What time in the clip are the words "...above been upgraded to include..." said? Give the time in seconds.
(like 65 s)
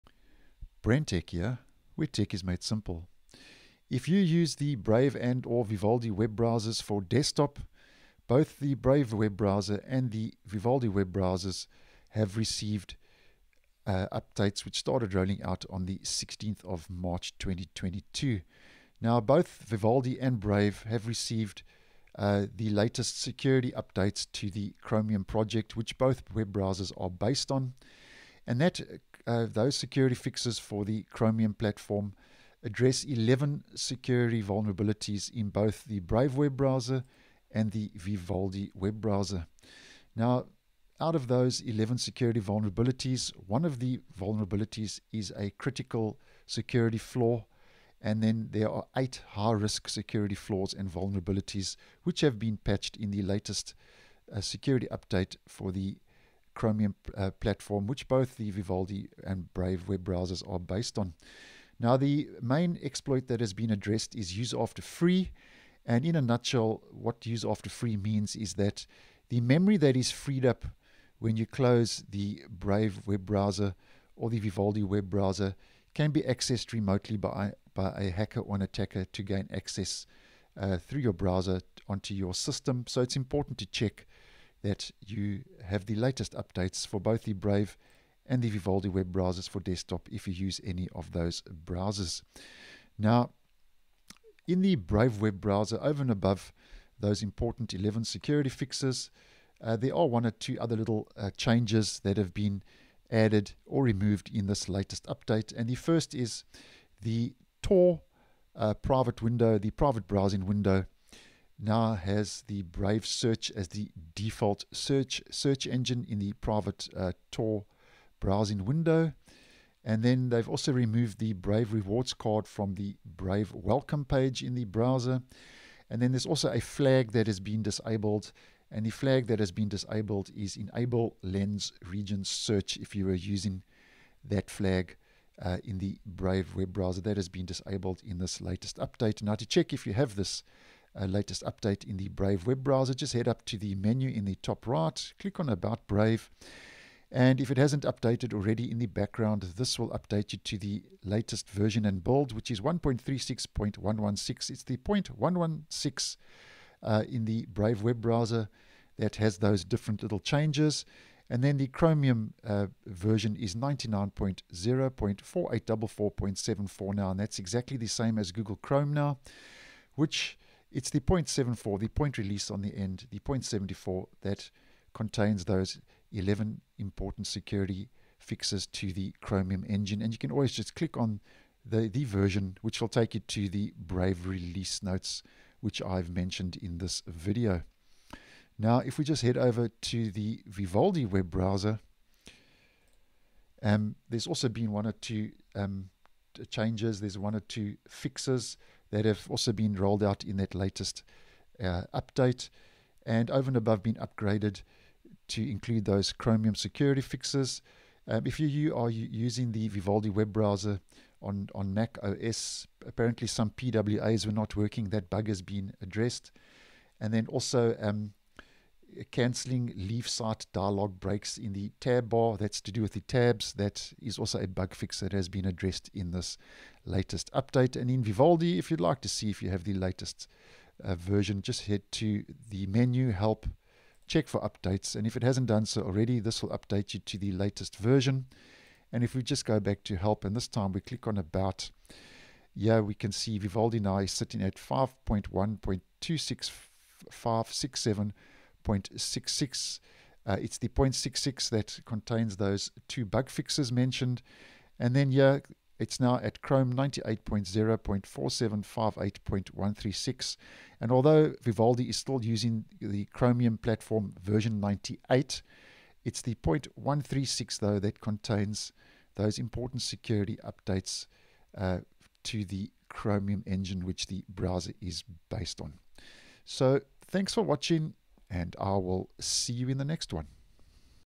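203 s.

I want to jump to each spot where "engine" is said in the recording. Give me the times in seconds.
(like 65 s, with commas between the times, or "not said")
115 s, 179 s, 273 s.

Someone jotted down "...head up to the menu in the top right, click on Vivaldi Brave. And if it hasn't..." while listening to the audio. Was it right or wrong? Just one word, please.
wrong.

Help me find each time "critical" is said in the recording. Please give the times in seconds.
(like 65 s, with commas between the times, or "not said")
45 s.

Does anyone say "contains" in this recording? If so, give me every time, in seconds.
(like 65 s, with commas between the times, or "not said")
174 s, 251 s, 268 s.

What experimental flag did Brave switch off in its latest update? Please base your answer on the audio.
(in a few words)
Enable Lens Region Search.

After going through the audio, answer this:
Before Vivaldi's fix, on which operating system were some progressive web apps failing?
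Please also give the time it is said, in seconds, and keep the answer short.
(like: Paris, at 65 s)
Mac OS, at 211 s.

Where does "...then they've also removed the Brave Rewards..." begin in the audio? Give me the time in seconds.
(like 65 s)
120 s.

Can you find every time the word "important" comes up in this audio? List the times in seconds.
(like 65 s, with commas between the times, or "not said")
83 s, 97 s, 176 s, 269 s.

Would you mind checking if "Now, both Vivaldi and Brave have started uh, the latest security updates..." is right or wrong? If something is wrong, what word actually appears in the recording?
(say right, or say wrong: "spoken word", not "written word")
wrong: "received", not "started".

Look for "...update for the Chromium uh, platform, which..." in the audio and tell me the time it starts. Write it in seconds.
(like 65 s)
54 s.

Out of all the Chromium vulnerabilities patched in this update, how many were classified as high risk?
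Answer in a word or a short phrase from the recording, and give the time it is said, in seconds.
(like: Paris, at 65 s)
8, at 48 s.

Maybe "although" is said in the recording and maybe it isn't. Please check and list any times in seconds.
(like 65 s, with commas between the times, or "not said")
260 s.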